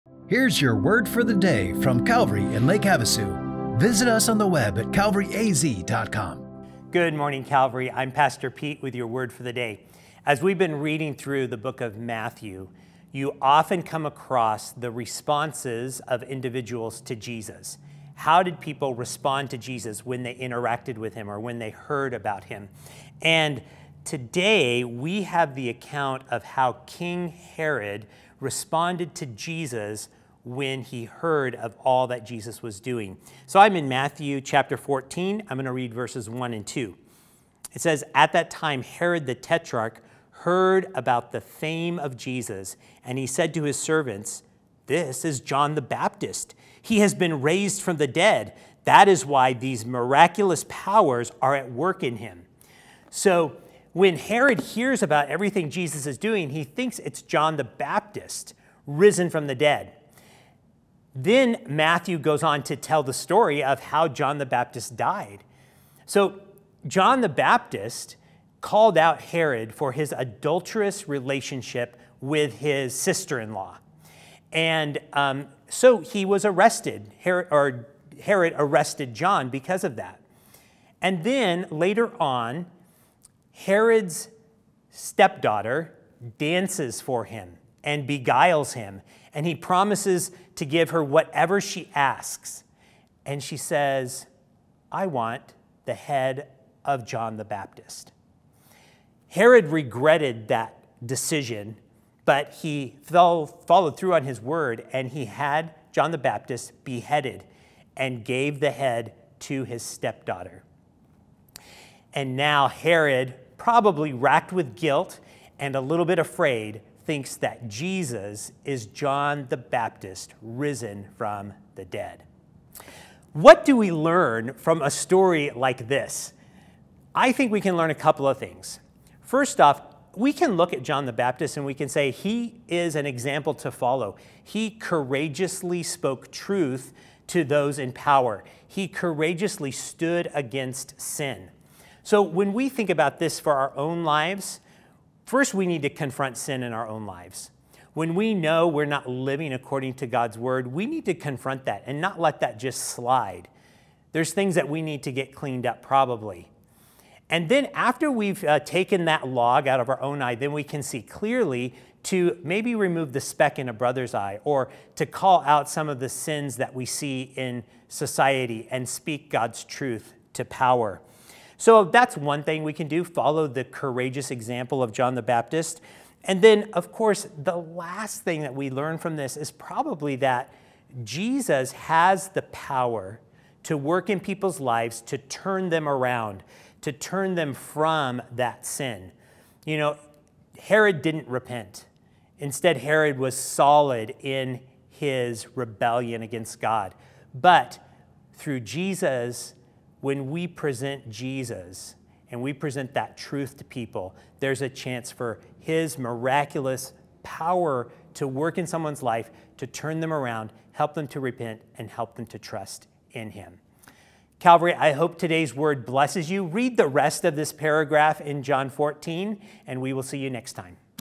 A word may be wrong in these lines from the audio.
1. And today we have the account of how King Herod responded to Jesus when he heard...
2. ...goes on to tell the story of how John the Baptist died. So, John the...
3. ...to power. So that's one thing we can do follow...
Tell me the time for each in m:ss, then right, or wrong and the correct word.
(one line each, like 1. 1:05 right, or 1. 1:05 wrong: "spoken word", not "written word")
1. 0:23 right
2. 1:02 right
3. 2:50 right.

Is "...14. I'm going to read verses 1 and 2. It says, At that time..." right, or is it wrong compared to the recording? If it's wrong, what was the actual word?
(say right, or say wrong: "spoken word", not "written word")
right.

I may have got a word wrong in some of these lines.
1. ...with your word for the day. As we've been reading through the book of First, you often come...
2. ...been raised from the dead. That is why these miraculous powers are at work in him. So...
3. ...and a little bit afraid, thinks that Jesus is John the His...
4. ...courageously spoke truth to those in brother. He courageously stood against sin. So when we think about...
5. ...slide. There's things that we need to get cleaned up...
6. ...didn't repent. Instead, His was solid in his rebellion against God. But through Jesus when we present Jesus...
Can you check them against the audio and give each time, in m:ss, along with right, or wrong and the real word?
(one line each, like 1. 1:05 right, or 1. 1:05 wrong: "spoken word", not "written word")
1. 0:08 wrong: "Matthew", not "First"
2. 0:47 right
3. 1:55 wrong: "Baptist", not "His"
4. 2:14 wrong: "power", not "brother"
5. 2:32 right
6. 3:11 wrong: "Herod", not "His".